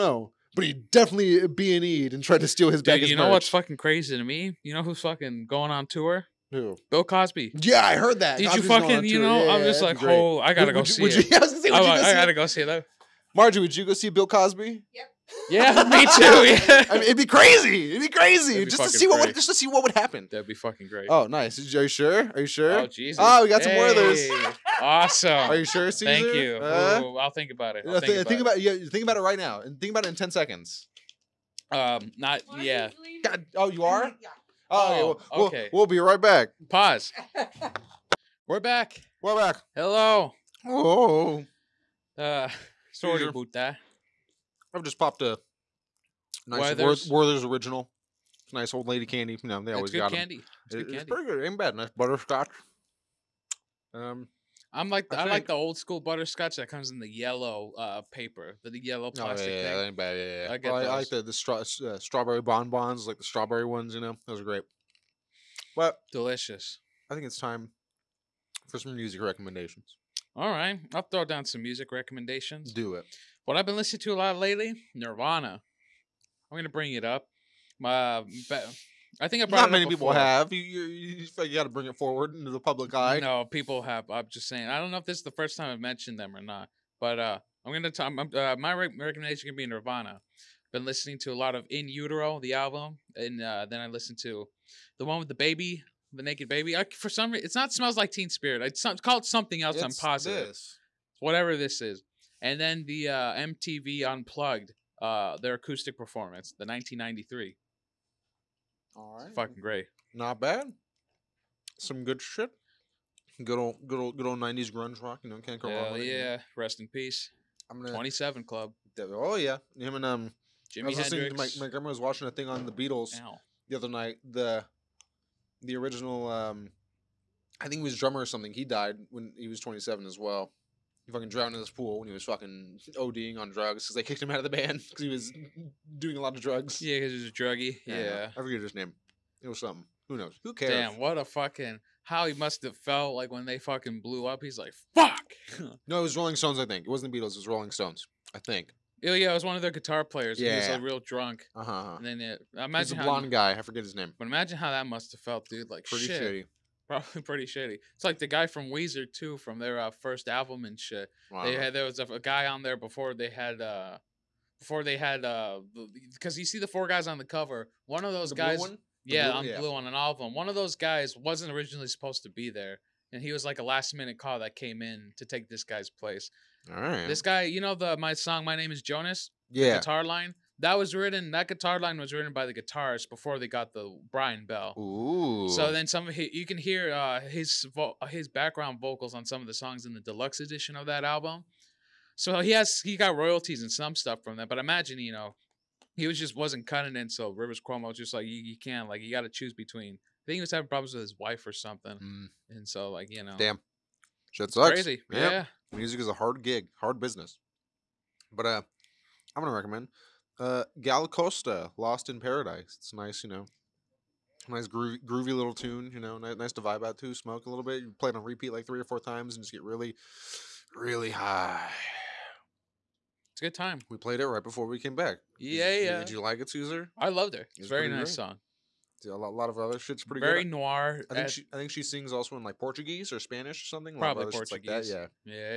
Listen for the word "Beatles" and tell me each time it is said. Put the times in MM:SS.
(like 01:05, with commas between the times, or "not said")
02:02, 02:27.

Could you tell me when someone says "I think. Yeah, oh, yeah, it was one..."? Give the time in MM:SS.
02:28.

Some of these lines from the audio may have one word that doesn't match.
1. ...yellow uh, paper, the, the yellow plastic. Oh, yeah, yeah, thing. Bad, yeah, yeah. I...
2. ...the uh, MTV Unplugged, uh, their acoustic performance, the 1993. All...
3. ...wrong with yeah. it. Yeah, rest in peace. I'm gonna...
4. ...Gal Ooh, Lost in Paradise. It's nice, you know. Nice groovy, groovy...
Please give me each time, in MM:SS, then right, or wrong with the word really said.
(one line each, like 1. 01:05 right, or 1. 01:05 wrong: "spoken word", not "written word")
1. 00:57 right
2. 01:42 right
3. 01:55 right
4. 03:30 wrong: "Costa", not "Ooh".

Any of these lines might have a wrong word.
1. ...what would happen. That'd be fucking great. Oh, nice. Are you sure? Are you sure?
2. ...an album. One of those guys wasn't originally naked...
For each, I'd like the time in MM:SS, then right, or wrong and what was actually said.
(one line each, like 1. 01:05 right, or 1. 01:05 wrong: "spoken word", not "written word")
1. 00:19 right
2. 02:49 wrong: "supposed", not "naked".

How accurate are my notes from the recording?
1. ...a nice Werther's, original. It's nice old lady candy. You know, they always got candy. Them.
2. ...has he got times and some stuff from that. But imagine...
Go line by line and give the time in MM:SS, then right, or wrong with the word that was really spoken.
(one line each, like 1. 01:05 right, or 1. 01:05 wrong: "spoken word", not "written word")
1. 00:45 right
2. 03:12 wrong: "royalties", not "times".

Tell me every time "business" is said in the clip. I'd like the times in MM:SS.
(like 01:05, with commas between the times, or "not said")
03:27.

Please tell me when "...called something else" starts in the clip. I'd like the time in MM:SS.
01:39.